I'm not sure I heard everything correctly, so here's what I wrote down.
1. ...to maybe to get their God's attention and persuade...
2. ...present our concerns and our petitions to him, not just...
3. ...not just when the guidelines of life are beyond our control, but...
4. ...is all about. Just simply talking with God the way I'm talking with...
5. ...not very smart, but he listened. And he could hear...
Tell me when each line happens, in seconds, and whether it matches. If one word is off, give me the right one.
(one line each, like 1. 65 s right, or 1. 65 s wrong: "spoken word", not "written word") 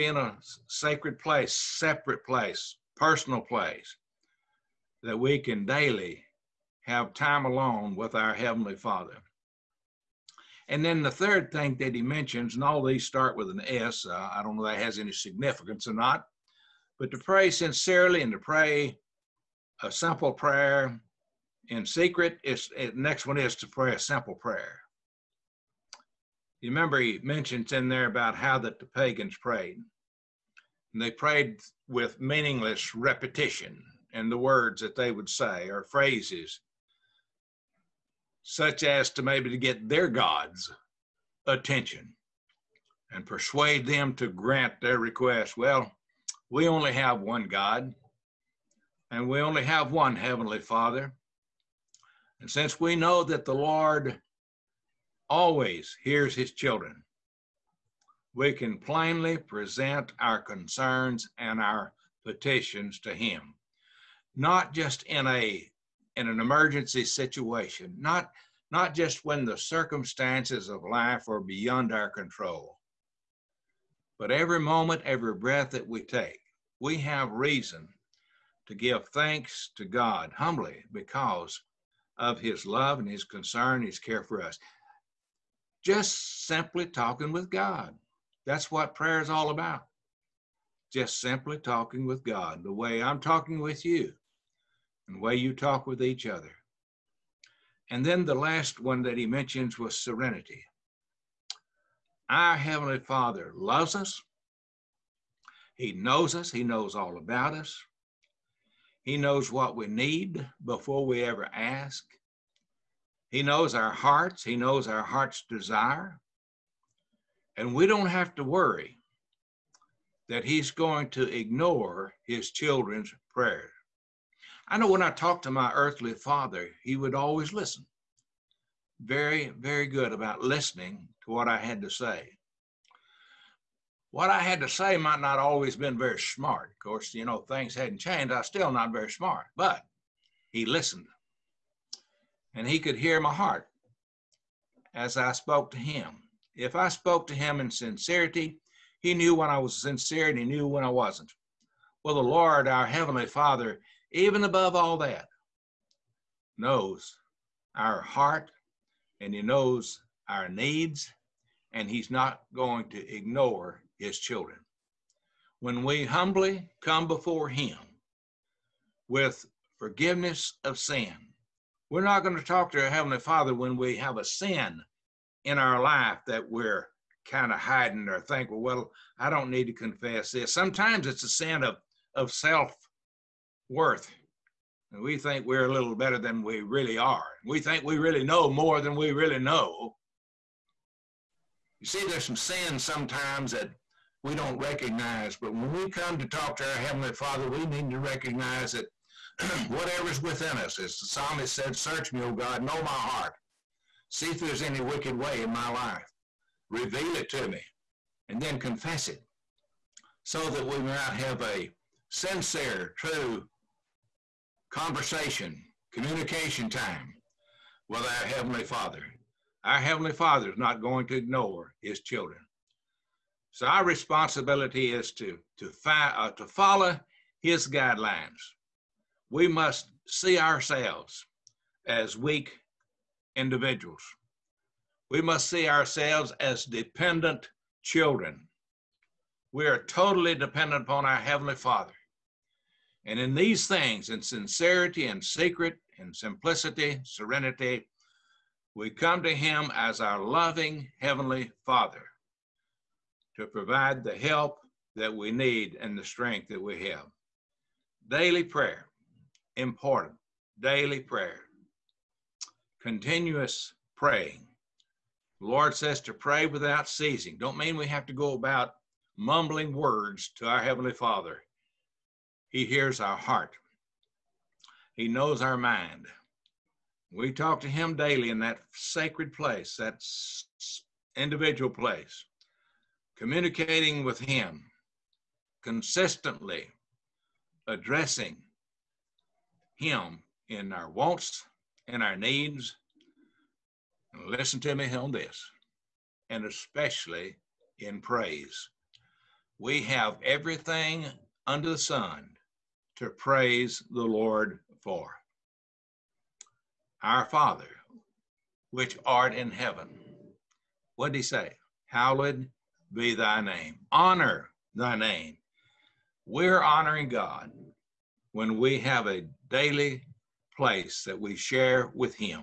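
1. 39 s right
2. 59 s right
3. 68 s wrong: "circumstances", not "guidelines"
4. 89 s right
5. 138 s right.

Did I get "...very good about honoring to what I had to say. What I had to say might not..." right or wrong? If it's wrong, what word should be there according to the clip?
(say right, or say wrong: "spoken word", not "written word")
wrong: "listening", not "honoring".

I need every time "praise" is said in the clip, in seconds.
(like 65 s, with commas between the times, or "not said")
297 s, 303 s.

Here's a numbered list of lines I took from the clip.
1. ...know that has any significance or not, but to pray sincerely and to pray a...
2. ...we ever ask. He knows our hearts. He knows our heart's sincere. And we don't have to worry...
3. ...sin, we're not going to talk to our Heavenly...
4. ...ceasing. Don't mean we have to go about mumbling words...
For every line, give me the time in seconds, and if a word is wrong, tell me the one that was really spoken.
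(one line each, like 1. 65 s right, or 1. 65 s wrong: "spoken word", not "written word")
1. 14 s right
2. 111 s wrong: "desire", not "sincere"
3. 170 s right
4. 266 s right.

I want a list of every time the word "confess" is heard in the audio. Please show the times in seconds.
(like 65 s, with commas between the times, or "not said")
179 s, 208 s.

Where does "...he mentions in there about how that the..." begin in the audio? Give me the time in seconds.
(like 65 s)
26 s.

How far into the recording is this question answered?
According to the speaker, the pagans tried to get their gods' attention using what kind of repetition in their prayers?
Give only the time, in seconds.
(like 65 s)
32 s.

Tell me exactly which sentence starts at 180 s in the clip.
Sometimes it's a sin of, of self worth.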